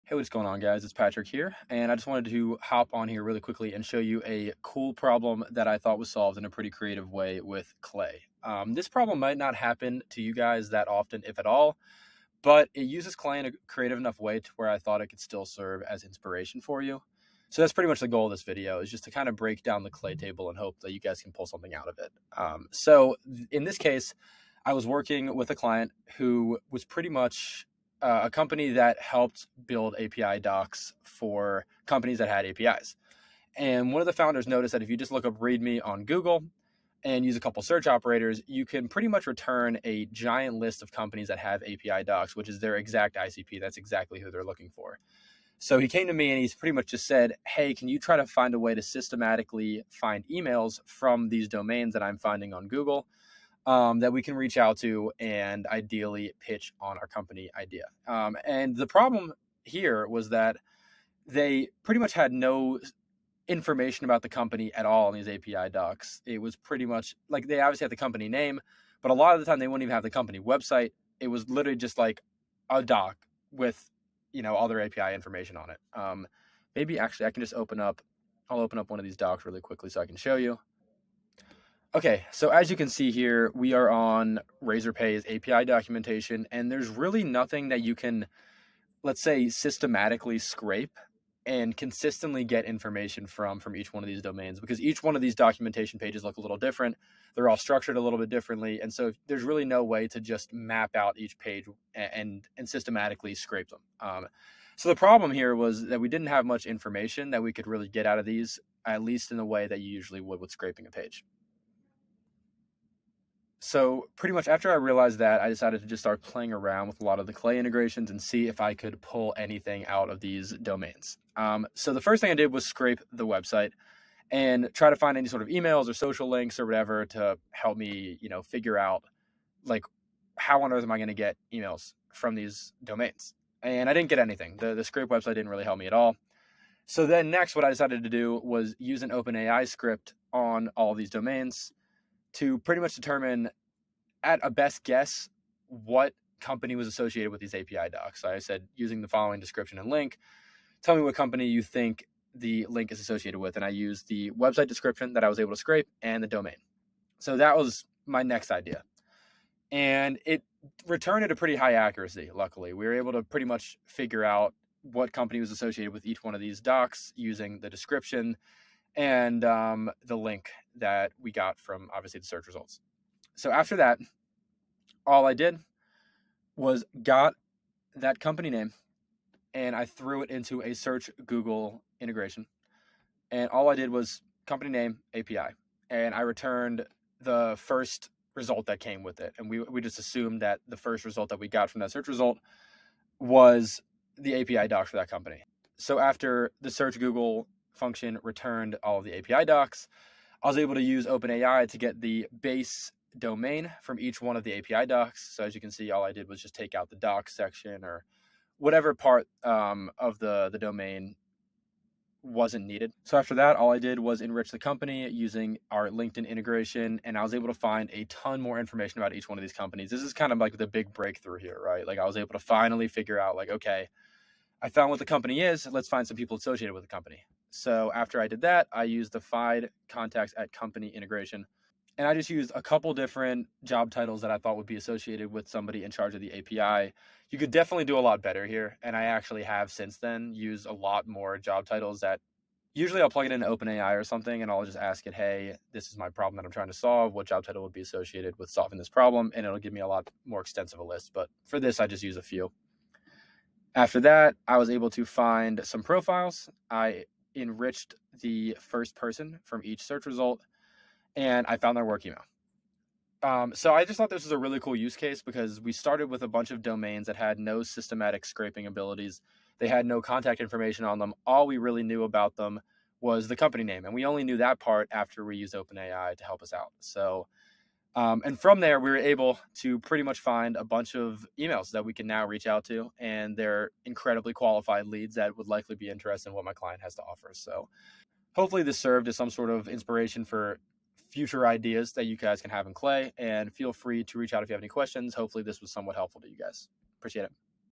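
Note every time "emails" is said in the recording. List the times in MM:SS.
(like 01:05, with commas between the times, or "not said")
00:50, 02:05, 02:11, 04:22, 04:41.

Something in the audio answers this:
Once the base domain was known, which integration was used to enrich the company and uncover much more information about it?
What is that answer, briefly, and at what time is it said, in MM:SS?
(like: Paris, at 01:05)
LinkedIn, at 03:35.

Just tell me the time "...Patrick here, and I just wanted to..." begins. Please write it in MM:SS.
00:00.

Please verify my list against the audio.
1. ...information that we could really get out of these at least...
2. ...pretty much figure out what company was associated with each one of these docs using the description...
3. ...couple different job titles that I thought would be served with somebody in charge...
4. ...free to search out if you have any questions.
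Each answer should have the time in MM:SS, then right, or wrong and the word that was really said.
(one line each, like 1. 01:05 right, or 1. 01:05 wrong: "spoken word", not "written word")
1. 01:46 right
2. 02:43 right
3. 03:52 wrong: "associated", not "served"
4. 04:53 wrong: "reach", not "search".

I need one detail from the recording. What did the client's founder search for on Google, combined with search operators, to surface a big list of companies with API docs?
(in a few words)
README.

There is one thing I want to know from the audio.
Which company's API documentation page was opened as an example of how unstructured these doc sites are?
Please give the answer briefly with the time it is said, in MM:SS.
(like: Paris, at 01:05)
Razorpay, at 01:24.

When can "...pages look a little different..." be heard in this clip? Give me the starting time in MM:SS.
01:35.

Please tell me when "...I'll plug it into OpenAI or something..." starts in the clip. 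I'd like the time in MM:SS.
04:03.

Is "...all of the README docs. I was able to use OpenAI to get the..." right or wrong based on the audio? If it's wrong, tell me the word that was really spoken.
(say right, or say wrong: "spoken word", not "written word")
wrong: "API", not "README".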